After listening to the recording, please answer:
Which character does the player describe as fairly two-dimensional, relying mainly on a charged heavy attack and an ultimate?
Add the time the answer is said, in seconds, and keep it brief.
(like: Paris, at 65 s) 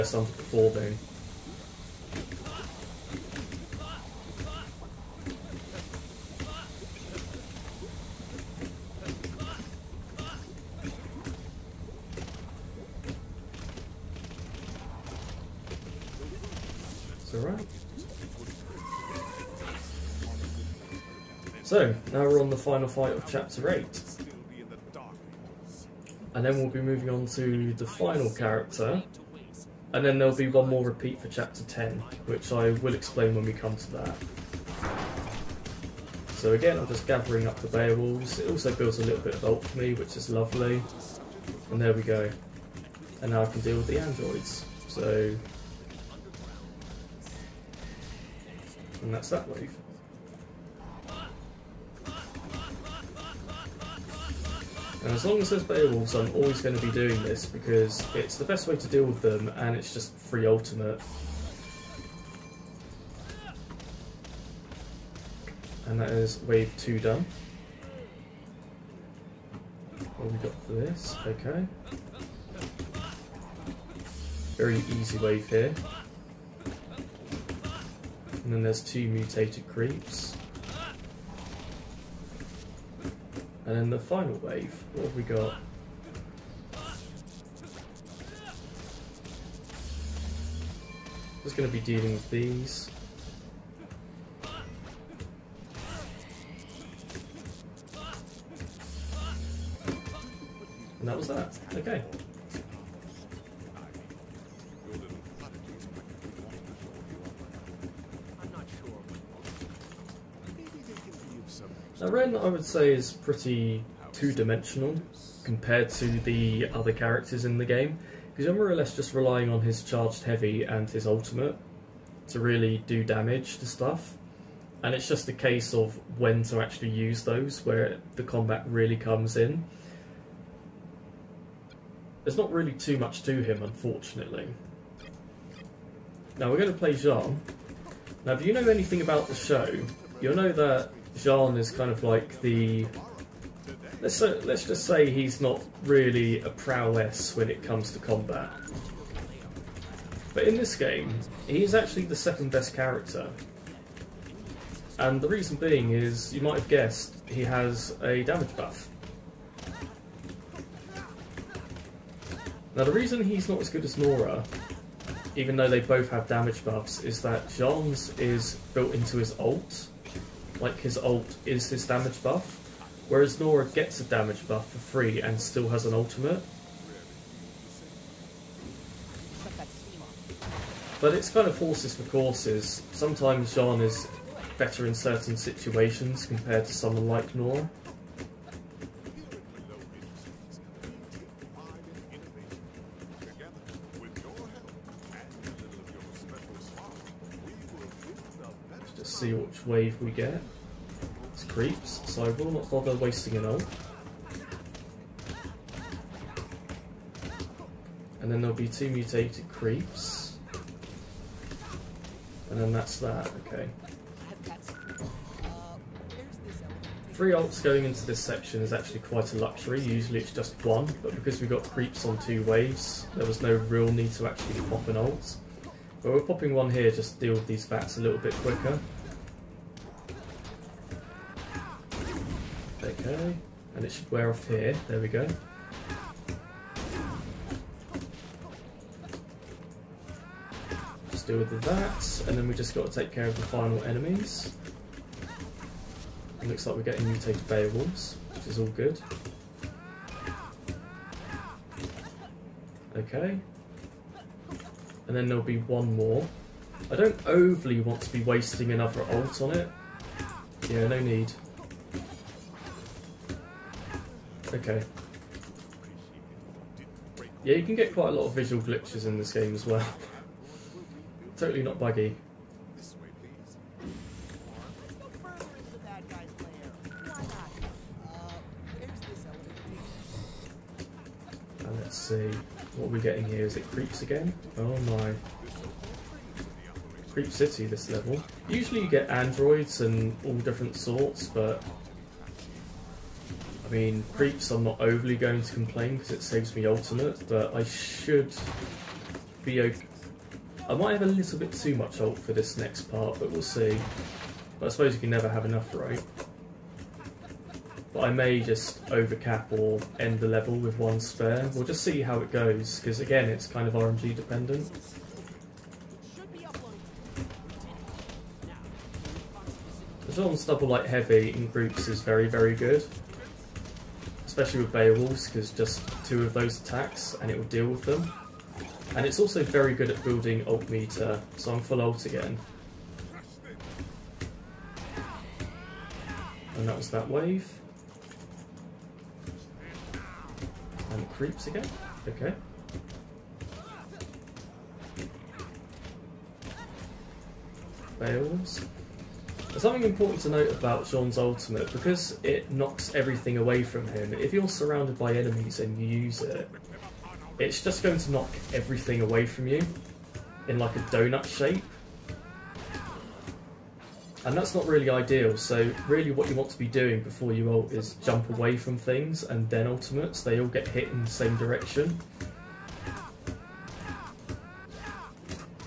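Ren, at 112 s.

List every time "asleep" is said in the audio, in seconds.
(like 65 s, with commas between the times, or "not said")
not said.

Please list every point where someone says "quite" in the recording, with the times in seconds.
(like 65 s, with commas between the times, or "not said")
218 s, 267 s.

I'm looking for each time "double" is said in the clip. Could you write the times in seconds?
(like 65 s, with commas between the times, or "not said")
320 s.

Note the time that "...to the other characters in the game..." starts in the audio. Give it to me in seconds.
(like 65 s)
115 s.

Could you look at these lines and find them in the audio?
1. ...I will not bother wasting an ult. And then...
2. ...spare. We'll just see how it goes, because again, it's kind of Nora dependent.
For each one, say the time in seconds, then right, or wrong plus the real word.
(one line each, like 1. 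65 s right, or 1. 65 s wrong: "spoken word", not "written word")
1. 202 s right
2. 310 s wrong: "RNG", not "Nora".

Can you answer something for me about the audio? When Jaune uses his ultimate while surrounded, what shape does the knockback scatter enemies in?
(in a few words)
donut shape.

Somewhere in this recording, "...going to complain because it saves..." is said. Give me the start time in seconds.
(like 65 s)
295 s.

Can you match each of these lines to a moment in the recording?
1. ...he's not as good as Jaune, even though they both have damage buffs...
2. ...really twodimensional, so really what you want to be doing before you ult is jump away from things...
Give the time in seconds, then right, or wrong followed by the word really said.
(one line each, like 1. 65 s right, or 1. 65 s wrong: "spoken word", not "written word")
1. 163 s wrong: "Nora", not "Jaune"
2. 364 s wrong: "ideal", not "twodimensional".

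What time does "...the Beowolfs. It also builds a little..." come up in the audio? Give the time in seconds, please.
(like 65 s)
37 s.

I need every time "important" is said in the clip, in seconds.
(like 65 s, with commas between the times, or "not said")
349 s.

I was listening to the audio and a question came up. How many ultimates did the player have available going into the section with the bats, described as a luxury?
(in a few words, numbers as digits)
3.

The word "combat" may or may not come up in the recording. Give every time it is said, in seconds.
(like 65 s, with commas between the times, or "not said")
128 s, 147 s.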